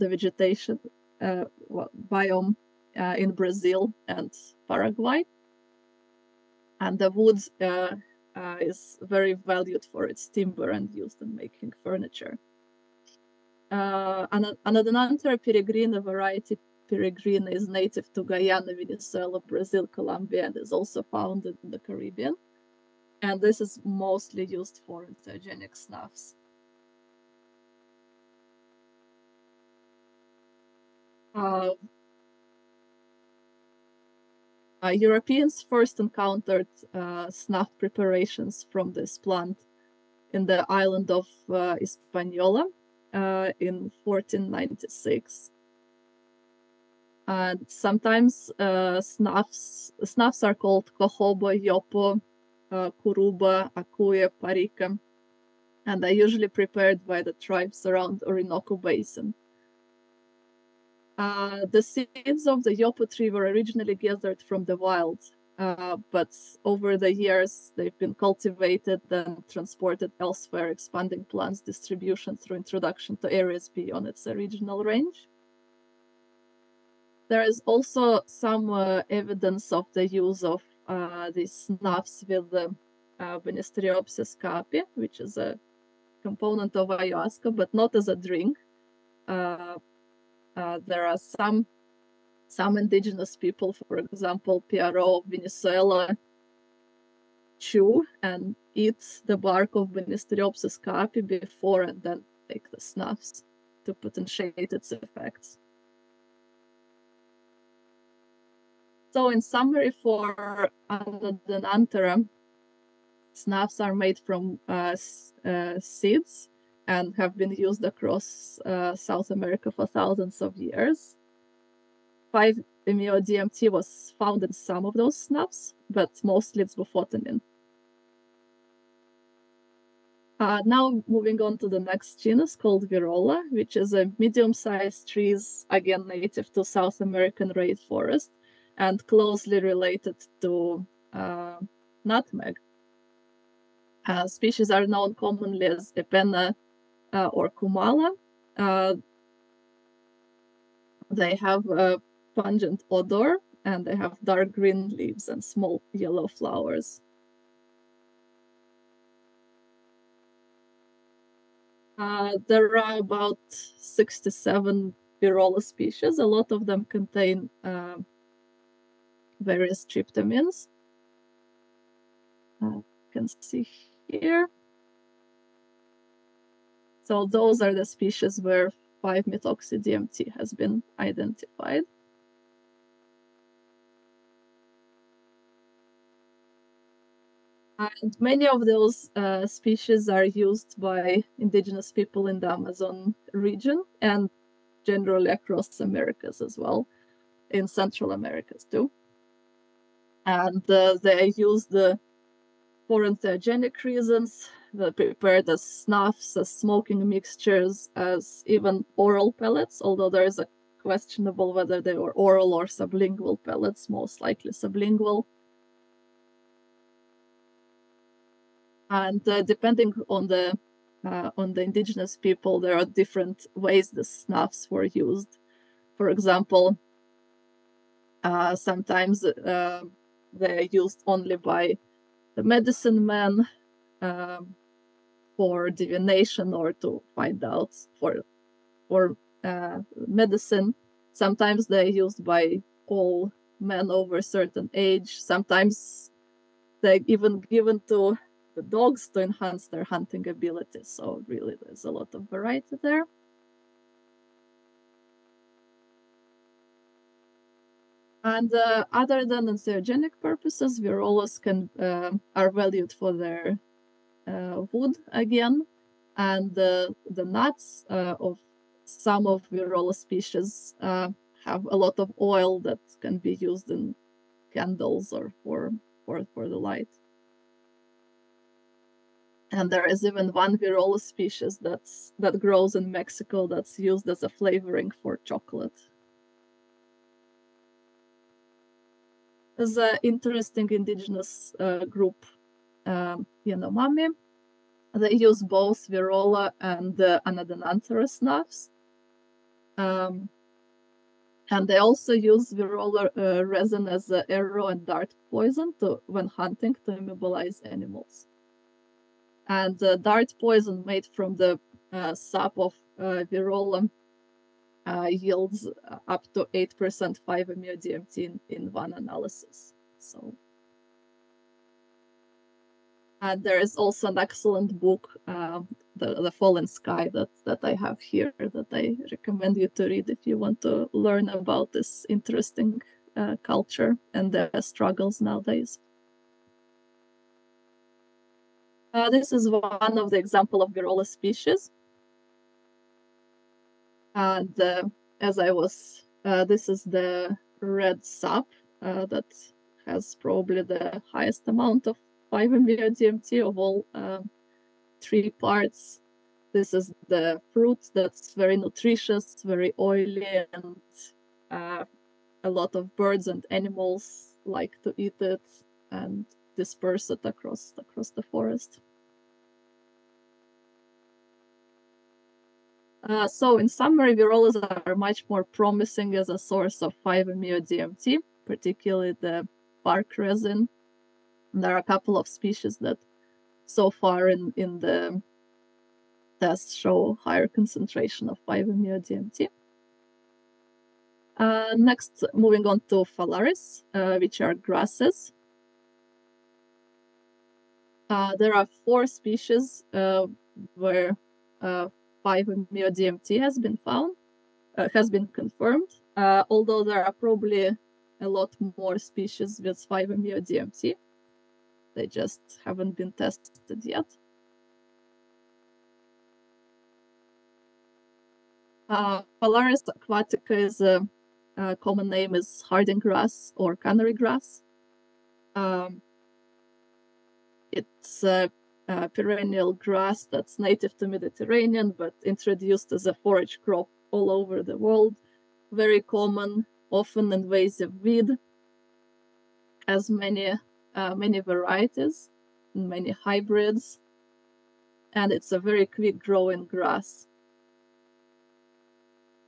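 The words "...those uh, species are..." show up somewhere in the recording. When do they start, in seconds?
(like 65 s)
188 s.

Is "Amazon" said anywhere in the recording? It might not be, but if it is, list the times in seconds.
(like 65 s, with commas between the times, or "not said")
192 s.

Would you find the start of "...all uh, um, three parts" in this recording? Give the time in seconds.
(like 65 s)
353 s.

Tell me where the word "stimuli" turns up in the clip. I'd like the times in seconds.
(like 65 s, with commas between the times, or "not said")
not said.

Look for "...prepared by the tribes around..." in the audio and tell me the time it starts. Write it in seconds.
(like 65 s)
56 s.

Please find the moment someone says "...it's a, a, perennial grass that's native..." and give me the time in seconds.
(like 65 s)
427 s.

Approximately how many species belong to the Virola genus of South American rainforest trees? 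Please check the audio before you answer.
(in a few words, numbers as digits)
67.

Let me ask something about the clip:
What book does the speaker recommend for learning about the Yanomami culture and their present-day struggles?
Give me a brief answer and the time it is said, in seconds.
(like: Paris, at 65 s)
The Falling Sky, at 326 s.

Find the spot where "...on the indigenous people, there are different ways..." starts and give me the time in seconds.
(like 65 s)
221 s.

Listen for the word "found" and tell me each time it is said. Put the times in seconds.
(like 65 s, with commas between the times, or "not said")
21 s, 124 s, 403 s.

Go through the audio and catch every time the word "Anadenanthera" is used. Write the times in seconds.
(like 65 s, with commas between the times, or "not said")
111 s, 297 s.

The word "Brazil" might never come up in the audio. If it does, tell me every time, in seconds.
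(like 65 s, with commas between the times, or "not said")
3 s, 19 s.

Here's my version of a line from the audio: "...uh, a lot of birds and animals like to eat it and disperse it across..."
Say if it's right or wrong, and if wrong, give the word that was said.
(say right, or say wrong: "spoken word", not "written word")
right.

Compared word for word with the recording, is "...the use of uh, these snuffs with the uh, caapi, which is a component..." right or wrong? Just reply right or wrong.
right.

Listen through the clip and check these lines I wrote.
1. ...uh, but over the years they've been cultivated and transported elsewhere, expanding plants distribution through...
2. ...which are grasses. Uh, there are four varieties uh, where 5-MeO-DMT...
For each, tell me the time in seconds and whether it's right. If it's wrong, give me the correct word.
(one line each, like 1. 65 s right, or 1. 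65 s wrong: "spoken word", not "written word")
1. 65 s right
2. 394 s wrong: "species", not "varieties".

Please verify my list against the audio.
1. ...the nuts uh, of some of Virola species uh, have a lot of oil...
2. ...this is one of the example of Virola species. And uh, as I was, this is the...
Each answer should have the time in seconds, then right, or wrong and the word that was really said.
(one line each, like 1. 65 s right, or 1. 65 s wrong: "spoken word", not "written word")
1. 266 s right
2. 339 s right.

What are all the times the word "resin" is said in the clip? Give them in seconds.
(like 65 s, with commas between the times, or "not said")
303 s, 380 s.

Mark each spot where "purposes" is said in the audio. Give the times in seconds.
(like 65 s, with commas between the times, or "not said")
260 s.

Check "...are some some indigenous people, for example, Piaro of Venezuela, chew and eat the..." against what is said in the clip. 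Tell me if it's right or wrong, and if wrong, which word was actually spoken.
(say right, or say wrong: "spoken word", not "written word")
right.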